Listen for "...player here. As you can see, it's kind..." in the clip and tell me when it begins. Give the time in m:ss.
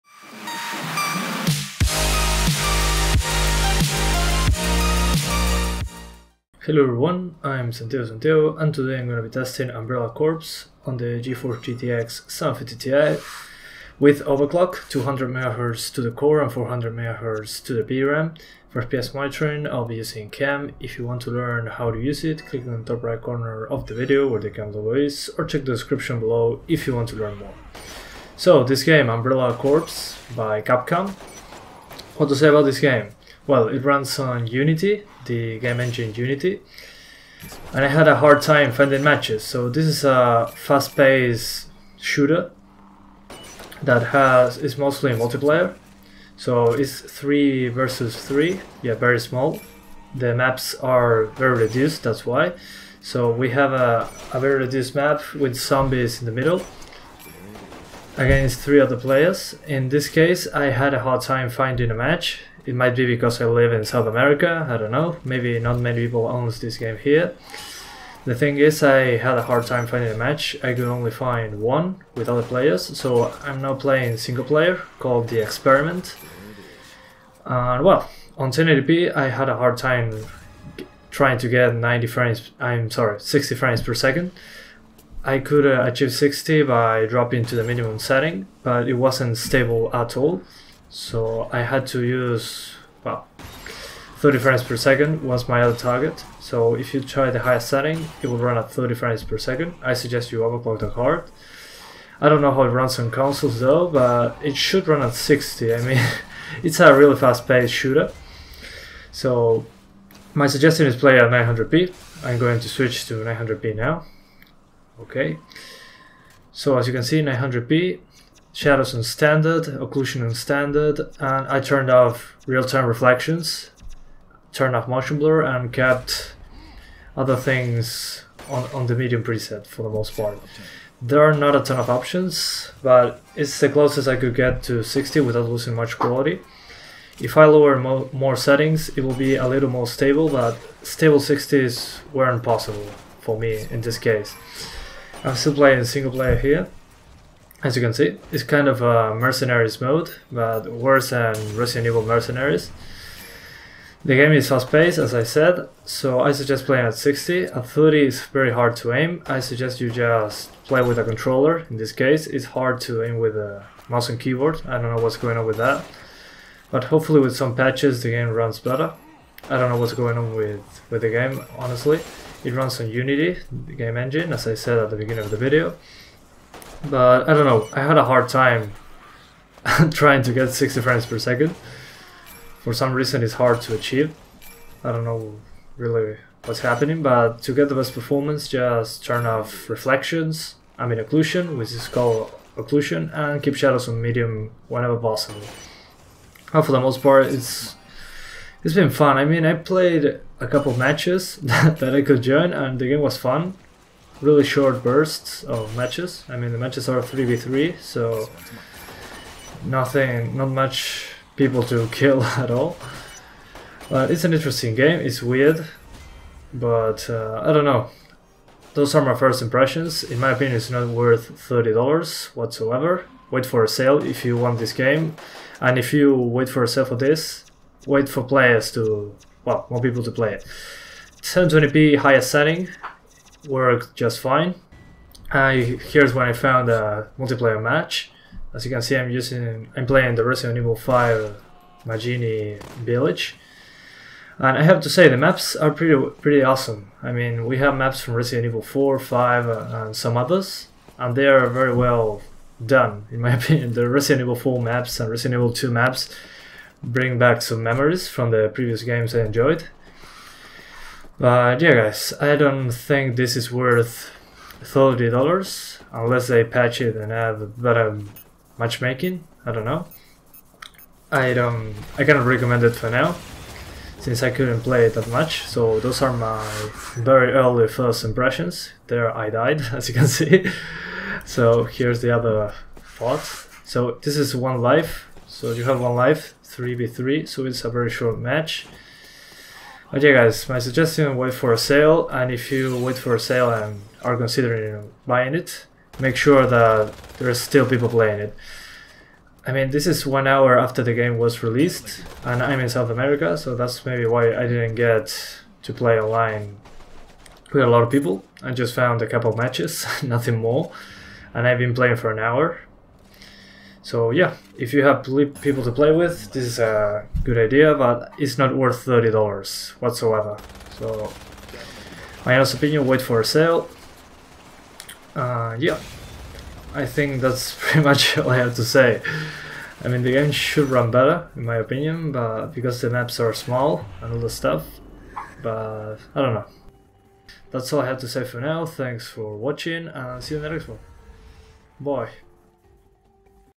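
2:26.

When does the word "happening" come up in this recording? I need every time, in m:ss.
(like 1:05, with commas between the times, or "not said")
3:06.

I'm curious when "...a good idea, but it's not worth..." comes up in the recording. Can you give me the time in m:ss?
5:16.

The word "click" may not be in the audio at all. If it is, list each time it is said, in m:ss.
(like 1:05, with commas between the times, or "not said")
0:22.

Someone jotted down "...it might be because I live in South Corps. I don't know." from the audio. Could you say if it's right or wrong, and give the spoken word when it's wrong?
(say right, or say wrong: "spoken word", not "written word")
wrong: "America", not "Corps".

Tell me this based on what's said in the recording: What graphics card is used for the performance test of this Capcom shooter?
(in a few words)
GeForce GTX 750 Ti.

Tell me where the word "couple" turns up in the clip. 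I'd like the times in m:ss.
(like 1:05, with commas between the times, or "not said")
3:20, 5:09.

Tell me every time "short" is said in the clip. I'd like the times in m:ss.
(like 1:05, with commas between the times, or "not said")
3:24, 4:47.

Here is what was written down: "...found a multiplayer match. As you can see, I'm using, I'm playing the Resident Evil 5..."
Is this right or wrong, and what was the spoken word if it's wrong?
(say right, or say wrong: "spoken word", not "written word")
right.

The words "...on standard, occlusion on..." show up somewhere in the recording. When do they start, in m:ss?
1:58.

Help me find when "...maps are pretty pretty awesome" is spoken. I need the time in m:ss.
4:05.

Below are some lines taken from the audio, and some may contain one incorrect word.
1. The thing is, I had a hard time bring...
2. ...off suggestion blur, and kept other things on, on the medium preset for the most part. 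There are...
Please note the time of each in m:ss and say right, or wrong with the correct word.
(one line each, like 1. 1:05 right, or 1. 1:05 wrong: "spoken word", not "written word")
1. 1:08 wrong: "finding", not "bring"
2. 2:04 wrong: "motion", not "suggestion".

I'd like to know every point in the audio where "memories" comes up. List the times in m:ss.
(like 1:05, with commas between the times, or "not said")
4:17.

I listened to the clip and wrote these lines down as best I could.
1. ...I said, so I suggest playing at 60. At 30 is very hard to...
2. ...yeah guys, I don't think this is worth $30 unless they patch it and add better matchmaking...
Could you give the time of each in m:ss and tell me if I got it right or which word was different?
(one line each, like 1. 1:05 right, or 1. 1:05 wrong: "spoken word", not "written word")
1. 2:35 right
2. 4:21 right.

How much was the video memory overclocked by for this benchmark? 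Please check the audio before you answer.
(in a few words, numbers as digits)
400 MHz.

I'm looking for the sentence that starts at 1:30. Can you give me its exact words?
So I had to use, well, 30 frames per second was my other target.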